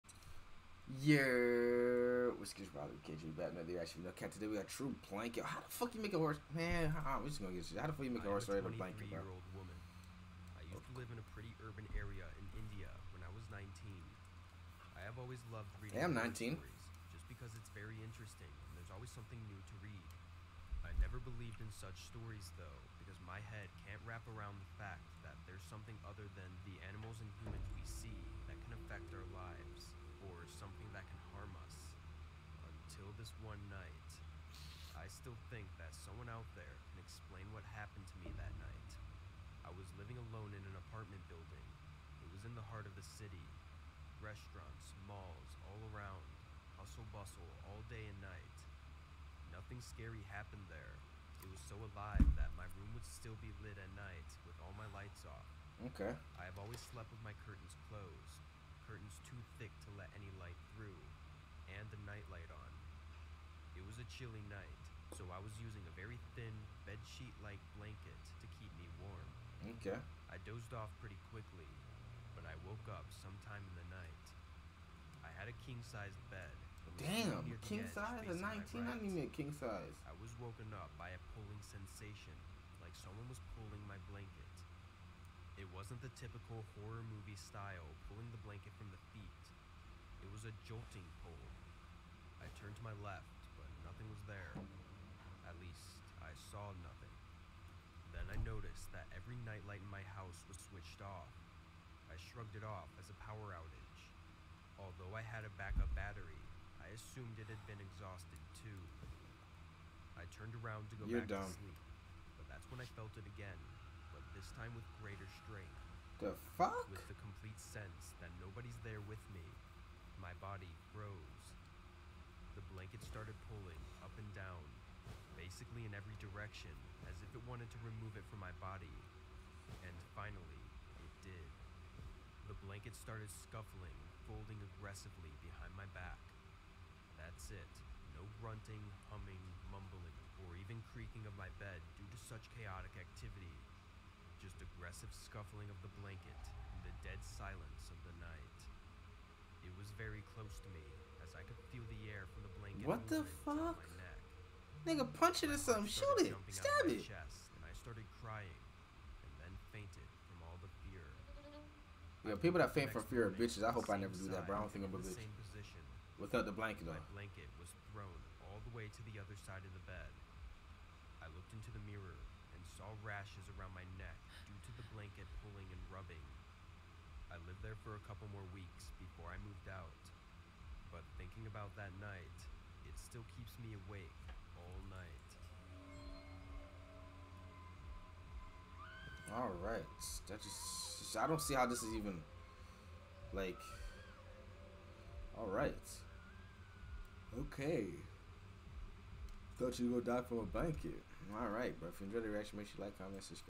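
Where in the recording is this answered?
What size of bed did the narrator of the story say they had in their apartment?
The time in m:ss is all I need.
1:15.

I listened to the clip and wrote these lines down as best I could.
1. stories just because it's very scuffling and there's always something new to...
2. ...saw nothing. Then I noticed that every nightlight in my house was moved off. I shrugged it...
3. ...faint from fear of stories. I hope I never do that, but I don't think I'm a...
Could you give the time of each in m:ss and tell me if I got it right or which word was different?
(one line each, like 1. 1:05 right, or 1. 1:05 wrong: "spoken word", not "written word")
1. 0:16 wrong: "interesting", not "scuffling"
2. 1:36 wrong: "switched", not "moved"
3. 2:42 wrong: "bitches", not "stories".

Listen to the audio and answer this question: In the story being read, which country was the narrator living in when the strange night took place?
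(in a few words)
India.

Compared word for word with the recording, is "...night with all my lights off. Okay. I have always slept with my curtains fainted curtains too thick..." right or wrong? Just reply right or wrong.
wrong.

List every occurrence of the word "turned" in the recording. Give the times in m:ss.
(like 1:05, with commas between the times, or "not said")
1:32, 1:50.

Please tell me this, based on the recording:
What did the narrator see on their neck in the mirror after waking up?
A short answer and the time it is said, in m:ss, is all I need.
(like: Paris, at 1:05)
Rashes, at 2:53.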